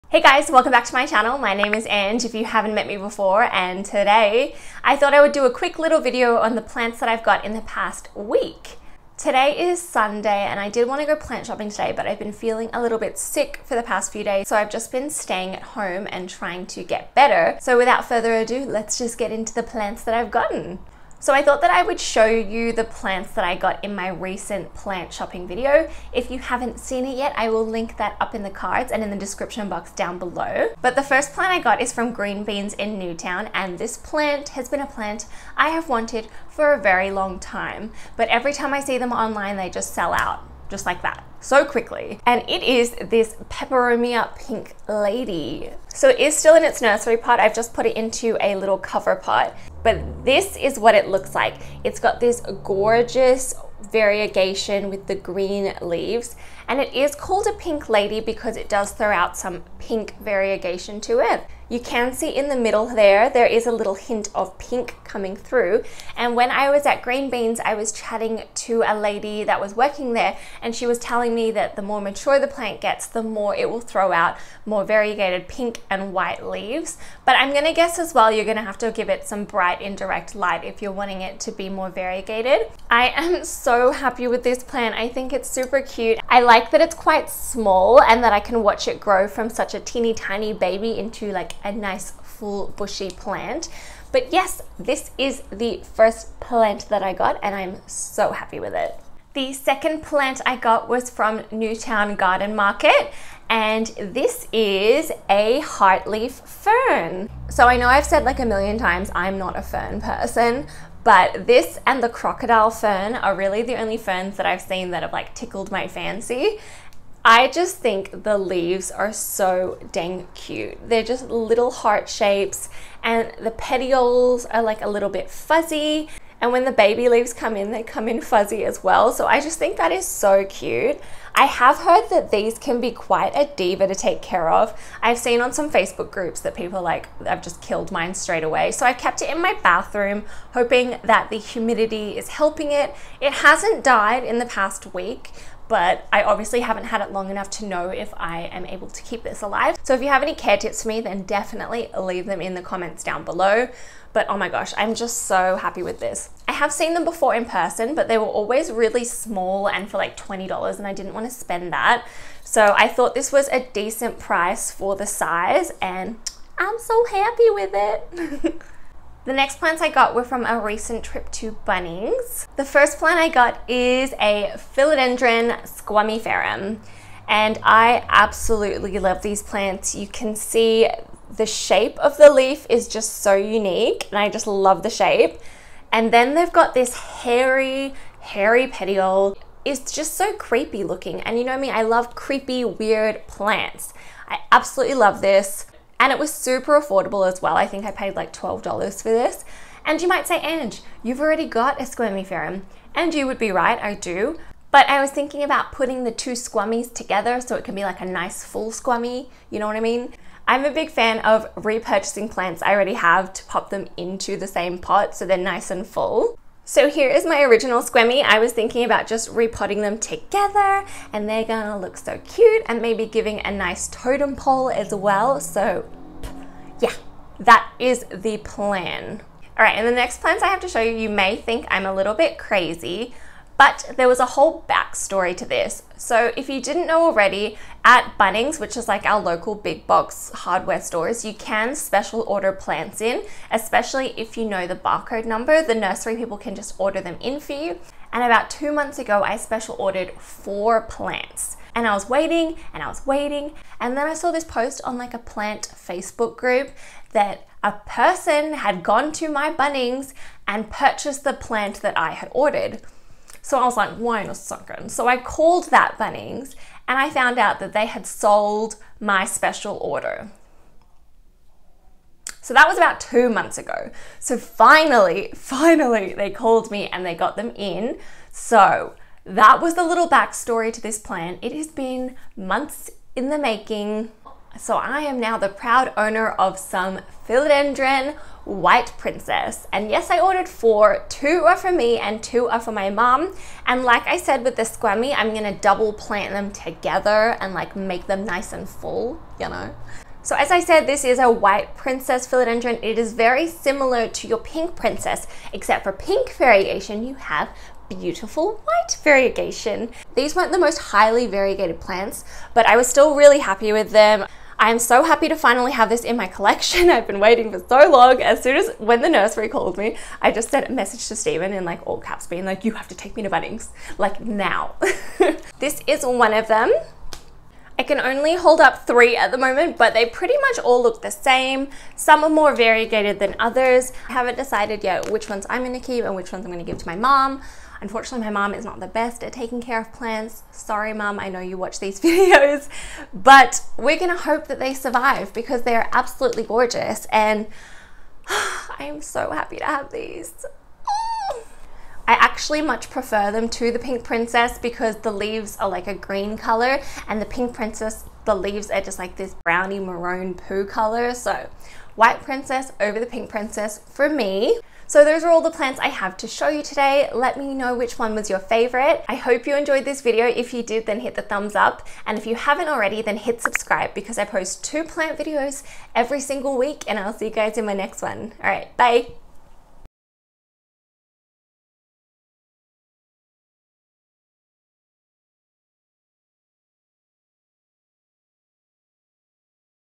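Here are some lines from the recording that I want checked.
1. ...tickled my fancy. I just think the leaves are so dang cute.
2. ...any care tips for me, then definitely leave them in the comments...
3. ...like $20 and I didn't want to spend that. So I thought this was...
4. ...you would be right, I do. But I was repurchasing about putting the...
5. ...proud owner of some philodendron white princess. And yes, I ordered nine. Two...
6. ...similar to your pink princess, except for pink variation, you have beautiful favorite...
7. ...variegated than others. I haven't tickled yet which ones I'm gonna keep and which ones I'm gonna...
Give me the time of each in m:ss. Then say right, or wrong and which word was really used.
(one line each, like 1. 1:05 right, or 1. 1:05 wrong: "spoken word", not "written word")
1. 1:55 right
2. 2:30 right
3. 2:39 right
4. 3:23 wrong: "thinking", not "repurchasing"
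5. 4:45 wrong: "four", not "nine"
6. 5:03 wrong: "white", not "favorite"
7. 5:32 wrong: "decided", not "tickled".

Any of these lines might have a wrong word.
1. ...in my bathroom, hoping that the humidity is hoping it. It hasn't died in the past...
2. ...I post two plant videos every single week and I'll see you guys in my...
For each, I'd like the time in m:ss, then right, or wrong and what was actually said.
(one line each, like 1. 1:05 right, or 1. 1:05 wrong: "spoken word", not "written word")
1. 2:19 wrong: "helping", not "hoping"
2. 6:14 right.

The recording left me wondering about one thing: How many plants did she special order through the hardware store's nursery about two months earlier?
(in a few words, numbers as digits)
4.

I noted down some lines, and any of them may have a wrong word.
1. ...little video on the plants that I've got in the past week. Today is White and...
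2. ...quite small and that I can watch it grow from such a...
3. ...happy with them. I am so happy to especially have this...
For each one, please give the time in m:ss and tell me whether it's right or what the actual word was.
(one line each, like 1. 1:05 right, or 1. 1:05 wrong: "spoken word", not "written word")
1. 0:05 wrong: "Sunday", not "White"
2. 1:26 right
3. 5:13 wrong: "finally", not "especially".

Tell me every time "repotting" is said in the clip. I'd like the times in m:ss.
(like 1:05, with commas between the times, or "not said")
3:39.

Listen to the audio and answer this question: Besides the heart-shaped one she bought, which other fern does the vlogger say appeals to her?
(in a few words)
crocodile fern.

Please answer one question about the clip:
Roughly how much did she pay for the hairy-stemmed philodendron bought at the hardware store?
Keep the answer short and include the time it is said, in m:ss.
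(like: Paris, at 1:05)
$12, at 3:18.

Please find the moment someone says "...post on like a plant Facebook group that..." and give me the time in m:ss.
4:14.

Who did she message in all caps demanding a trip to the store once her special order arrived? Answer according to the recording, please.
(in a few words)
Stephen.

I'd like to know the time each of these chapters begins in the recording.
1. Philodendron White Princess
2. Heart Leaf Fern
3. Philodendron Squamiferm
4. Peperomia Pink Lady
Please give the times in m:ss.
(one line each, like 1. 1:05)
1. 3:50
2. 1:39
3. 2:52
4. 0:31.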